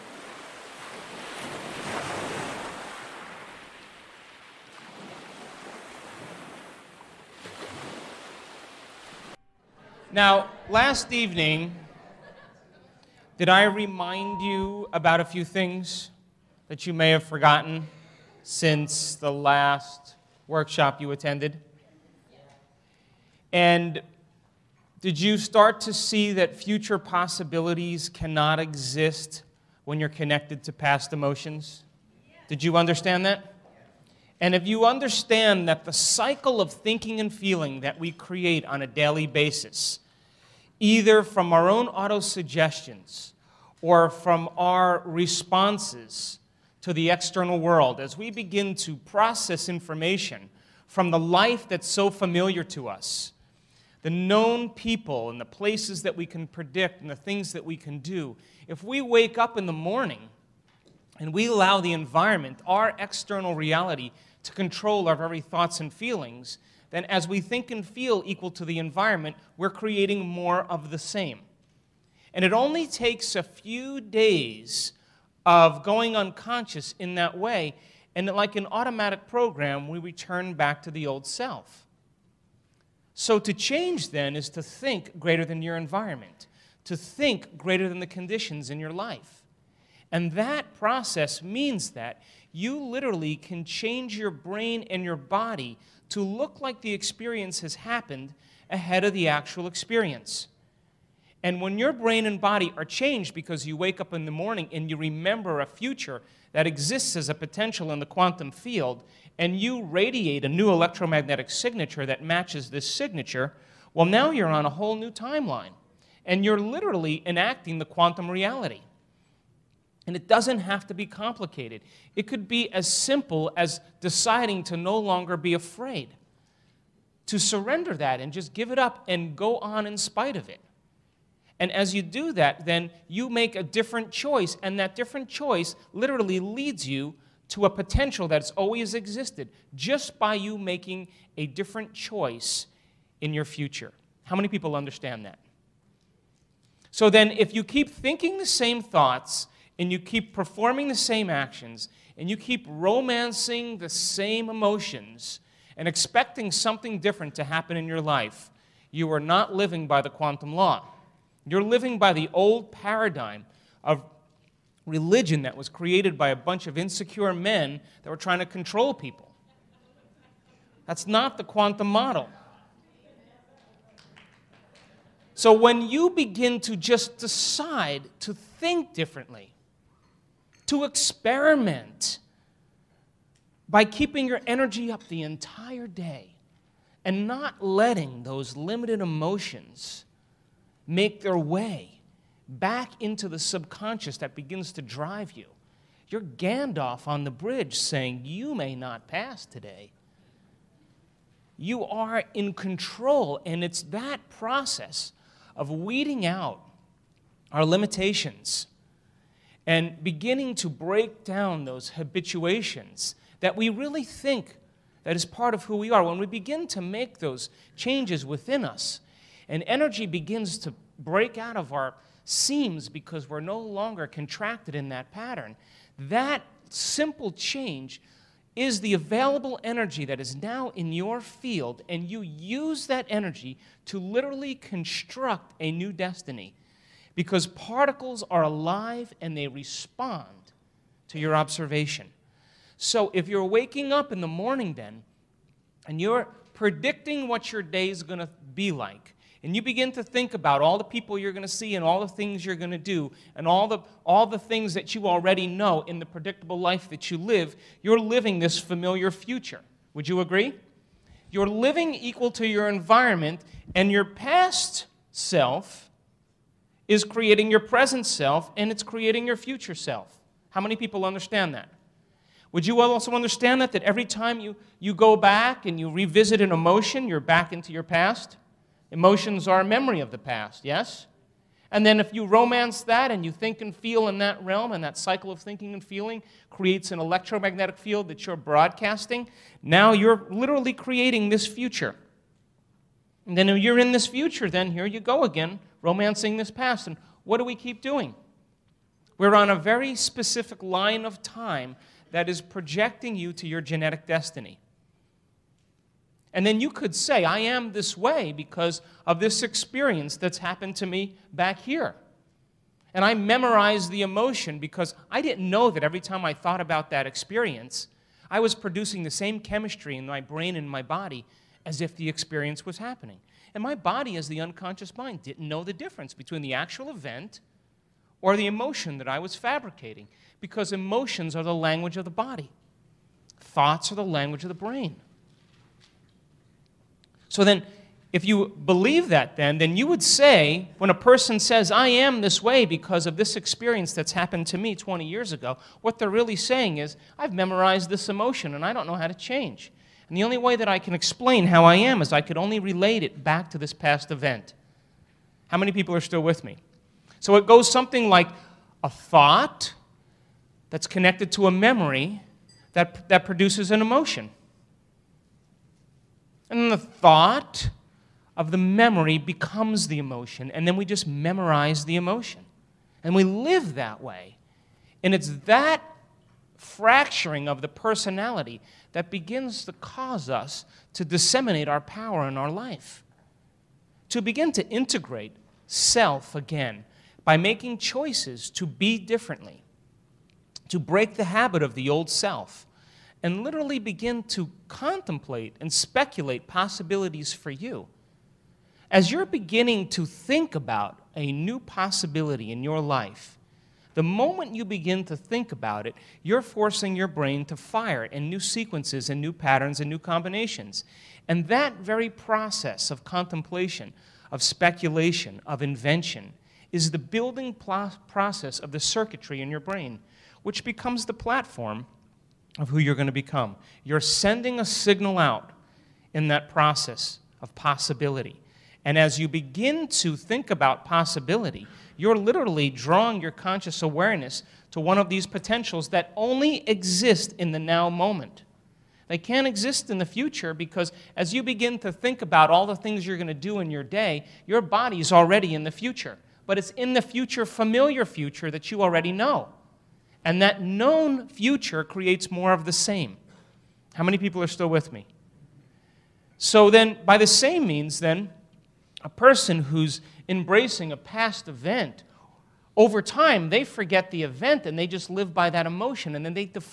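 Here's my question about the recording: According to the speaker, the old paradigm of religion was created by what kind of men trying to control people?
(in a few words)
insecure men.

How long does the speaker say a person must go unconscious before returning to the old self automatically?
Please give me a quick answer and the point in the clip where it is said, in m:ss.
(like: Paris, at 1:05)
a few days, at 1:13.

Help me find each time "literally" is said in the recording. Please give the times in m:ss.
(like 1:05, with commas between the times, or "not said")
1:32, 1:56, 2:15, 3:53, 4:50, 6:33, 7:12.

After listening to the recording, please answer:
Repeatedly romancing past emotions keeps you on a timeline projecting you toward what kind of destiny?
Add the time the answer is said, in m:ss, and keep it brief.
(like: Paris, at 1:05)
genetic destiny, at 5:03.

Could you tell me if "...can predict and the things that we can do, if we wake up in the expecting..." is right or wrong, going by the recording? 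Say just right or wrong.
wrong.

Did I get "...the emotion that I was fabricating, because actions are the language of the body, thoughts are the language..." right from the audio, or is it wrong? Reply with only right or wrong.
wrong.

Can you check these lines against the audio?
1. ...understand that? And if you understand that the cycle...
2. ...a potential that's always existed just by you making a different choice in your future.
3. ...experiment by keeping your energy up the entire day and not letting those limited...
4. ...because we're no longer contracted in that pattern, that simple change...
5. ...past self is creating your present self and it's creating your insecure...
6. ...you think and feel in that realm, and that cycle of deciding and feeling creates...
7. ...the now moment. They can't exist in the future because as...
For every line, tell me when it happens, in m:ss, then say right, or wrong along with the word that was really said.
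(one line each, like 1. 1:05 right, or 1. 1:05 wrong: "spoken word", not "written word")
1. 0:32 right
2. 2:17 right
3. 3:00 right
4. 3:42 right
5. 4:24 wrong: "future", not "insecure"
6. 4:43 wrong: "thinking", not "deciding"
7. 7:17 right.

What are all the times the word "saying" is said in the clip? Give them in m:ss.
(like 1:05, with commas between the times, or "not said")
3:17, 5:46.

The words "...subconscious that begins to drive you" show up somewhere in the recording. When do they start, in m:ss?
3:13.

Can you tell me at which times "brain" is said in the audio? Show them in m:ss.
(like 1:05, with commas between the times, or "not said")
1:34, 1:41, 5:20, 5:34, 6:47, 6:59.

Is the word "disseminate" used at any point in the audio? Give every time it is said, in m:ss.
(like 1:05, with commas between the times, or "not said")
6:21.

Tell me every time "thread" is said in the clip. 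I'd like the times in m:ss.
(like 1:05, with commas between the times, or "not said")
not said.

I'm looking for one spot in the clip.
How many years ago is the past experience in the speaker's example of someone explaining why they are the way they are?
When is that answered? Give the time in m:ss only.
5:44.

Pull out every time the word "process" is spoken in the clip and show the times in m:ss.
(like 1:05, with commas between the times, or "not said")
0:48, 1:30, 3:24, 6:52, 6:57, 7:06.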